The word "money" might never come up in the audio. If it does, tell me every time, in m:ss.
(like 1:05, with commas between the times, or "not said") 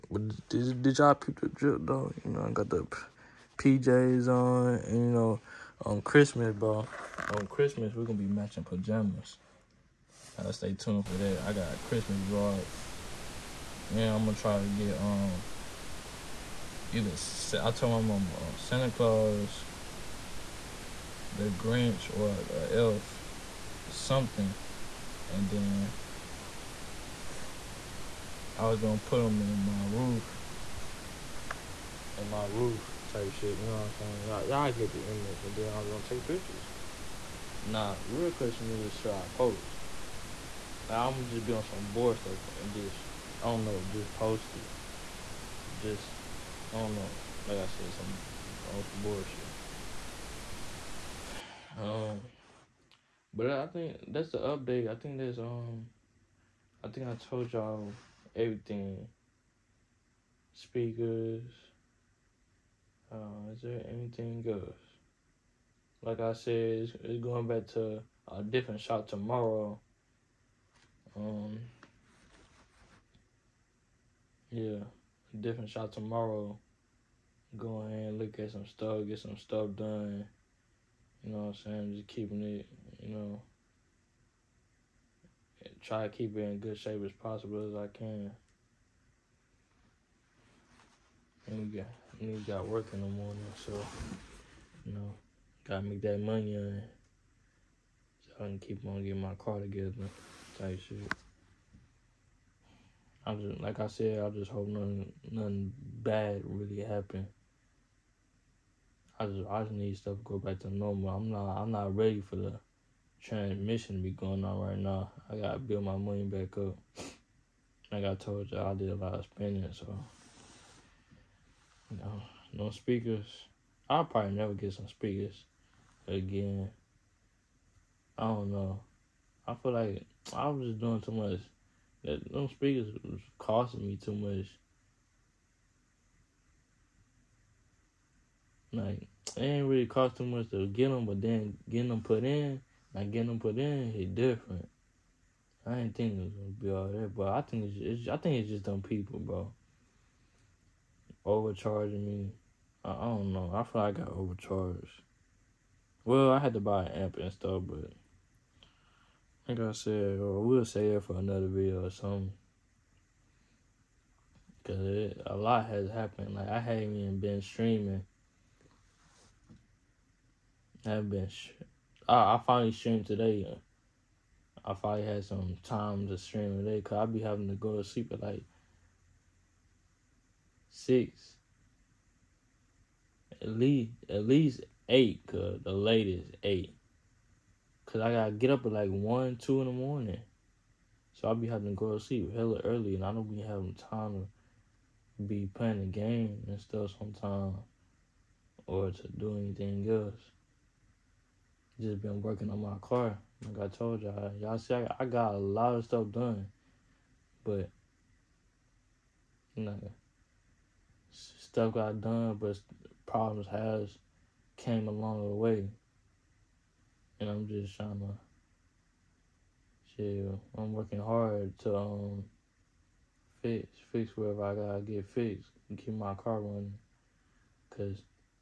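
1:36, 1:55.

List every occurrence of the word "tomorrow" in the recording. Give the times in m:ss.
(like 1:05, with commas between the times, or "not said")
1:09, 1:15.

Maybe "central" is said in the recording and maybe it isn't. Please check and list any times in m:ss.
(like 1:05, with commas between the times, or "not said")
not said.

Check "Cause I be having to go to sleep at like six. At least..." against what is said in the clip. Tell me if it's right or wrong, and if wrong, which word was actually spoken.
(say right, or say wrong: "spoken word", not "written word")
right.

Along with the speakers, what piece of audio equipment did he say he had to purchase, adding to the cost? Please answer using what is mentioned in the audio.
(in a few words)
An amp.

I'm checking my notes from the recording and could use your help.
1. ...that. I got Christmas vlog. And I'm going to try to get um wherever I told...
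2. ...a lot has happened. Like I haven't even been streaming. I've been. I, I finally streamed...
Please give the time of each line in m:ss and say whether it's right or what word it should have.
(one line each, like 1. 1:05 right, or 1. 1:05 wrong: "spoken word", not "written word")
1. 0:11 wrong: "either", not "wherever"
2. 2:45 right.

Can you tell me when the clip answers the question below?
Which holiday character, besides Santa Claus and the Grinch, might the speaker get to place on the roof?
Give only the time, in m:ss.
0:22.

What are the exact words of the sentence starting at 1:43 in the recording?
I just like I said, I just hope nothing nothing bad really happen.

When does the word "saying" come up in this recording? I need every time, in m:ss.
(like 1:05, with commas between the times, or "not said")
0:34, 1:21.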